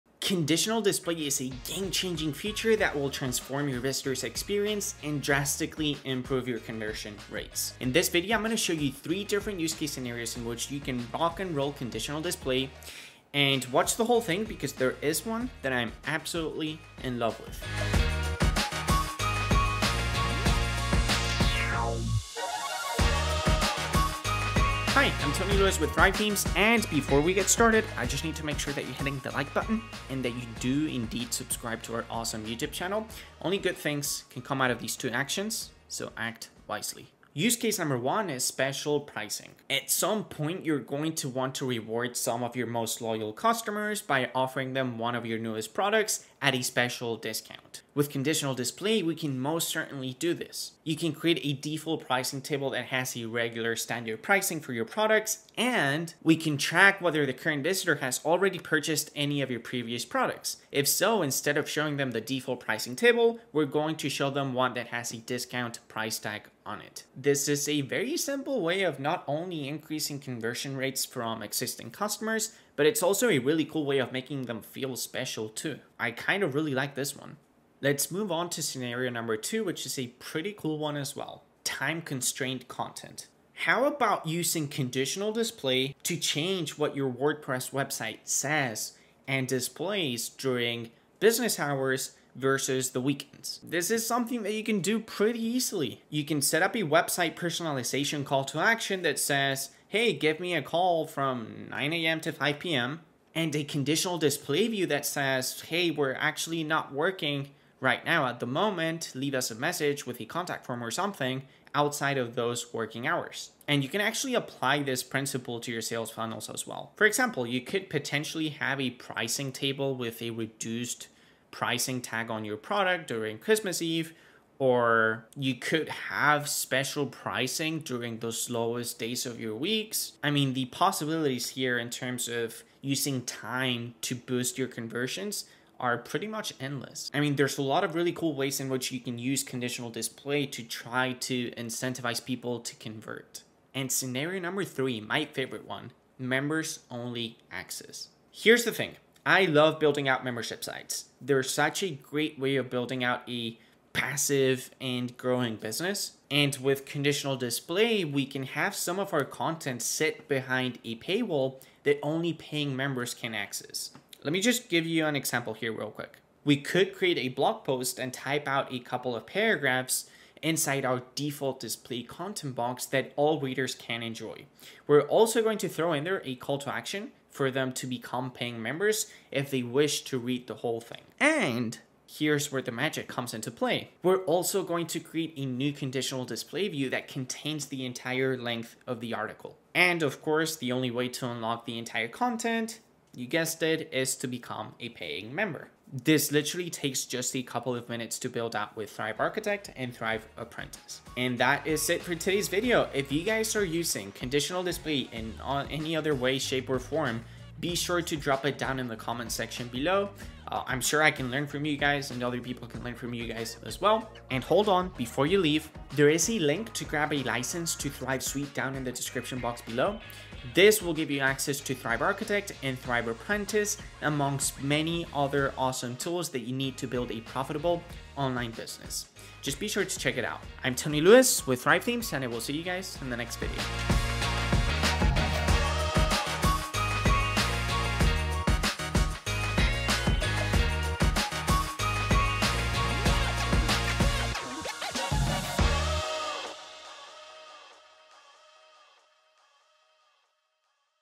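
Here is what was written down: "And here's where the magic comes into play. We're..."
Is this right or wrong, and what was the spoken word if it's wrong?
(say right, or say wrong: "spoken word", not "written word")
right.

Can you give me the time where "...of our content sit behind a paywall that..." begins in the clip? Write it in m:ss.
2:38.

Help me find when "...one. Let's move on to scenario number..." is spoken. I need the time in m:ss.
1:17.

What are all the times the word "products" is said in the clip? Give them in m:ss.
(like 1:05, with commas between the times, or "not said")
0:45, 0:54, 1:00, 2:02.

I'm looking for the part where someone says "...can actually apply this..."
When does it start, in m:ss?
1:53.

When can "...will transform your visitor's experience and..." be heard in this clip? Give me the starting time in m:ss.
0:02.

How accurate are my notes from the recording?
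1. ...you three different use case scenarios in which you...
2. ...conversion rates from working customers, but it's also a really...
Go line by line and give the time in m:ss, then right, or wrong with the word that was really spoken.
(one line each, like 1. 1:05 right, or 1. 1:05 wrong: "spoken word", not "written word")
1. 0:08 right
2. 1:10 wrong: "existing", not "working".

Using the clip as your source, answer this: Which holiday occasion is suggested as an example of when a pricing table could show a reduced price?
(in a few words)
Christmas Eve.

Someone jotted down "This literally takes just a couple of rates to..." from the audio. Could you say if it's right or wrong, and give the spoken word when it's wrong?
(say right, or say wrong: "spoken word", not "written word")
wrong: "minutes", not "rates".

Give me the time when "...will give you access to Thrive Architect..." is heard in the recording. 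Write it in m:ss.
3:40.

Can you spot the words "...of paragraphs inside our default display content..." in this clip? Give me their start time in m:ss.
2:49.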